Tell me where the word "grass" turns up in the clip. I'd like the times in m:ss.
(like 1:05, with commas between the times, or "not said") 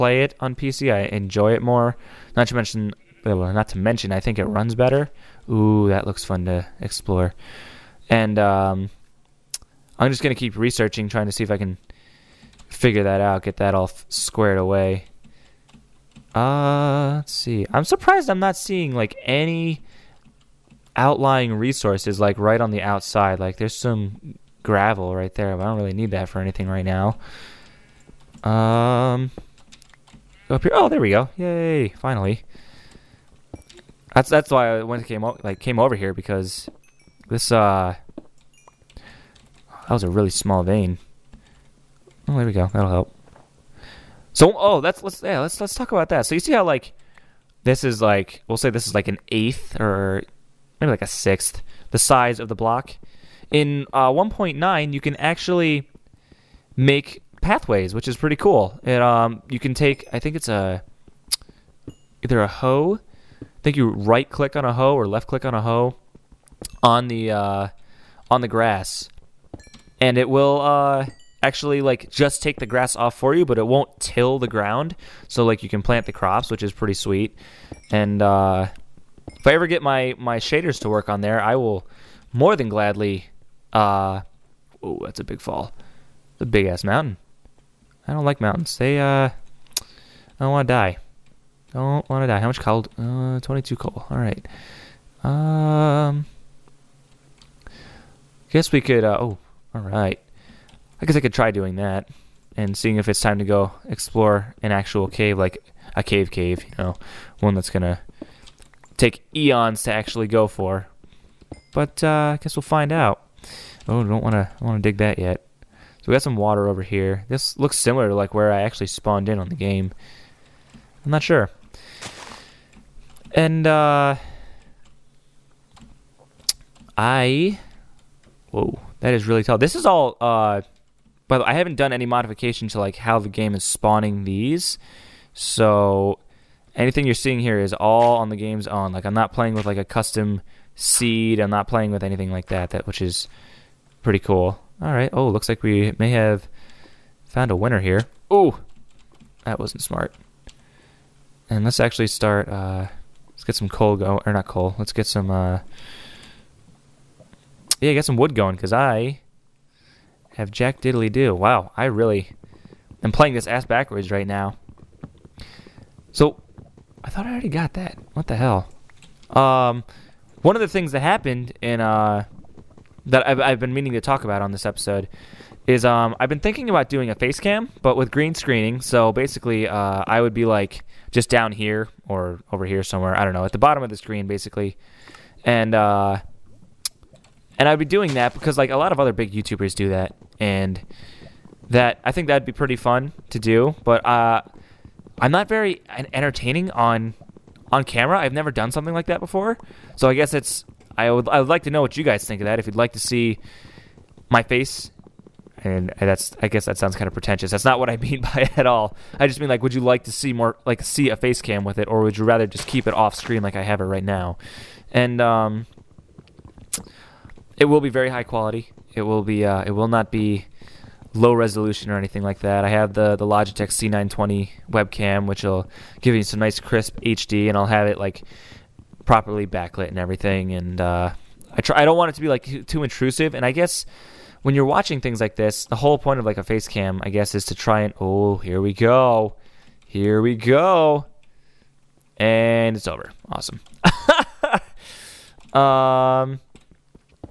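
1:08, 1:12.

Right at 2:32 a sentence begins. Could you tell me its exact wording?
Uh, let's get some coal going, or not coal.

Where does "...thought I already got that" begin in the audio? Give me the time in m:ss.
2:47.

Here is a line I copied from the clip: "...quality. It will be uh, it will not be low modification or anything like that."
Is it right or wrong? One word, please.
wrong.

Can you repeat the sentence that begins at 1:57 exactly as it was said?
This looks similar to like where I actually spawned in on the game.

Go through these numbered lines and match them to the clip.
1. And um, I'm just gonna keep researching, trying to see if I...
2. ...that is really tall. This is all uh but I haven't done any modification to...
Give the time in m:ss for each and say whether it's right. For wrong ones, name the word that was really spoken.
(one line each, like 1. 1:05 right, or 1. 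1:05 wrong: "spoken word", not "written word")
1. 0:08 right
2. 2:08 right.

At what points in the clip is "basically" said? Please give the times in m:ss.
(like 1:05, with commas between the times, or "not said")
2:59, 3:04.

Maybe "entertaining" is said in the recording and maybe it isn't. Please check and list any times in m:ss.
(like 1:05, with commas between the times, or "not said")
3:16.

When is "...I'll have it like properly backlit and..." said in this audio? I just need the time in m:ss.
3:47.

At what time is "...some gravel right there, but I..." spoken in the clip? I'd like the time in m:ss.
0:23.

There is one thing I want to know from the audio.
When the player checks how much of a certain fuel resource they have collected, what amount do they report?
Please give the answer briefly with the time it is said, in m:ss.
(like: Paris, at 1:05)
22, at 1:33.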